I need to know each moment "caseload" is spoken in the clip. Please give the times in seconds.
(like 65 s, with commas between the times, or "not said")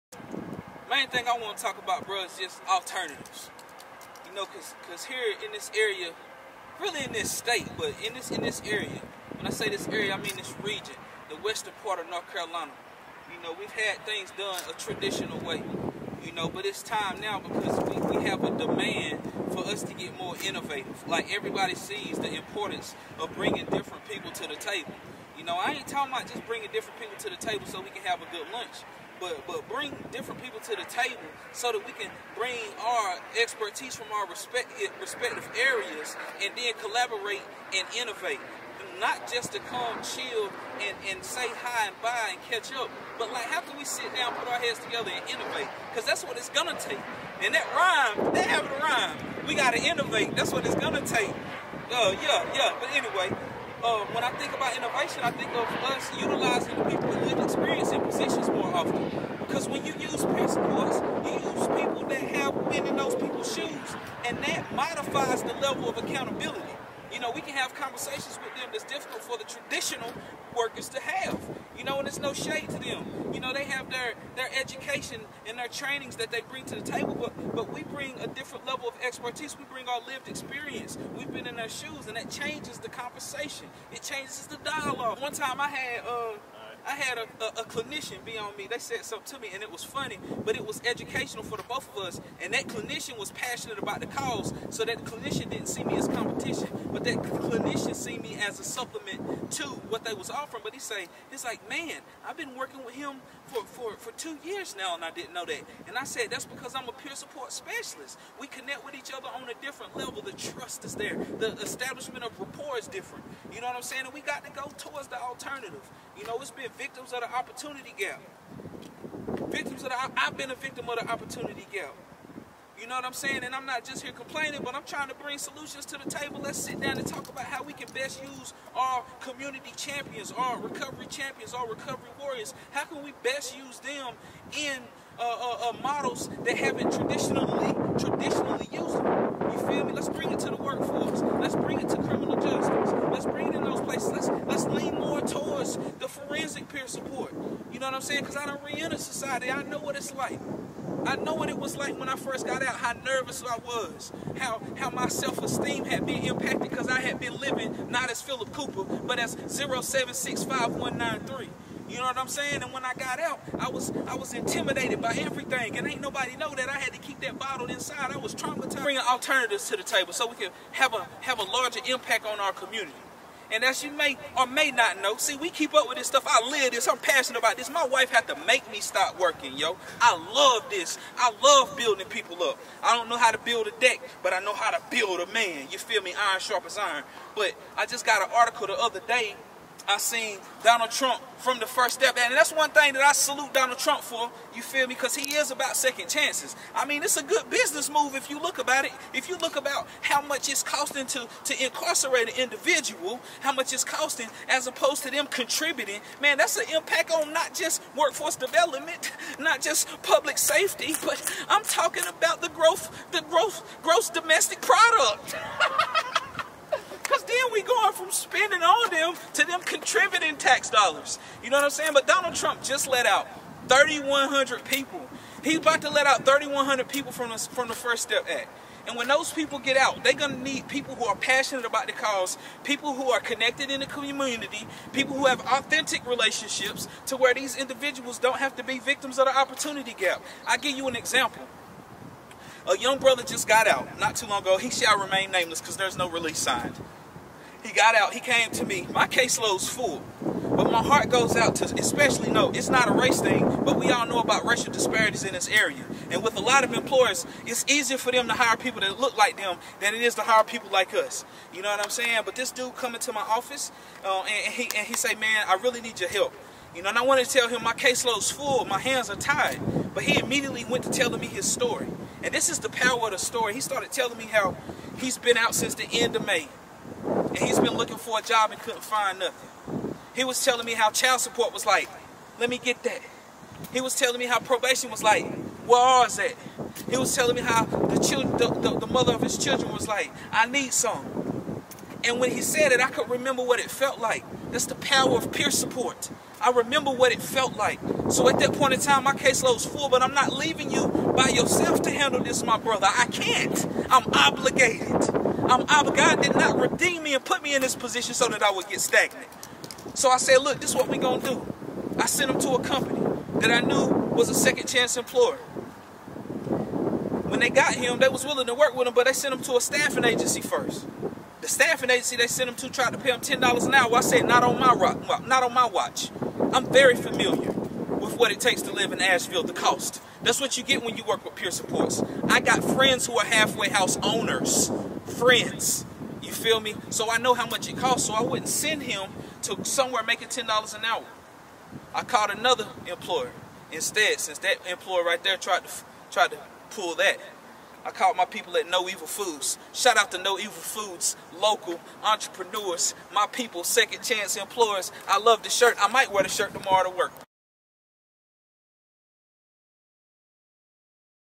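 249 s, 267 s, 299 s.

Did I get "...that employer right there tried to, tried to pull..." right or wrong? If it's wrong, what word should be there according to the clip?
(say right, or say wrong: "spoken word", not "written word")
right.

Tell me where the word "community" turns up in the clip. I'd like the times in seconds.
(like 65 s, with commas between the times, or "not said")
129 s, 172 s, 233 s.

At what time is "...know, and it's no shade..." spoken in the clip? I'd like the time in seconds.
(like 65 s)
71 s.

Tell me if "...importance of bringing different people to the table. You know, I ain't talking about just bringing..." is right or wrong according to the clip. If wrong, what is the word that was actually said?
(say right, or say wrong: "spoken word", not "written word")
right.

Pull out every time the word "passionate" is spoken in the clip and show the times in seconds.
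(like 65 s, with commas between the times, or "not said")
93 s, 176 s, 231 s.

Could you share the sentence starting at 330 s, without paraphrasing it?
That's what you get when you work with peer supports.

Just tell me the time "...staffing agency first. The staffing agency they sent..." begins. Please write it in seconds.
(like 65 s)
319 s.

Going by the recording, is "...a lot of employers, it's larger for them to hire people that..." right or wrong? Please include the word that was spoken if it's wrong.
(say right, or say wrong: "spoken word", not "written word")
wrong: "easier", not "larger".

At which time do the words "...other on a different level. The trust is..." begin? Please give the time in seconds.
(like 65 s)
109 s.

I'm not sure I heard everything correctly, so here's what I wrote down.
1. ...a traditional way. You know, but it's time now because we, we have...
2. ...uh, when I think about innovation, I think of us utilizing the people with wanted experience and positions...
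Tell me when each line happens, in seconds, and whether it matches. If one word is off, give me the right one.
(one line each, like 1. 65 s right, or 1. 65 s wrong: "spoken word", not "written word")
1. 14 s right
2. 53 s wrong: "lived", not "wanted".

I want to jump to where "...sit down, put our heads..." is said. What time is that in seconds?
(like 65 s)
43 s.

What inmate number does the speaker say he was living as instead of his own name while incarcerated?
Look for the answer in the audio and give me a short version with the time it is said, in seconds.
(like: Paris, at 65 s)
0765193, at 159 s.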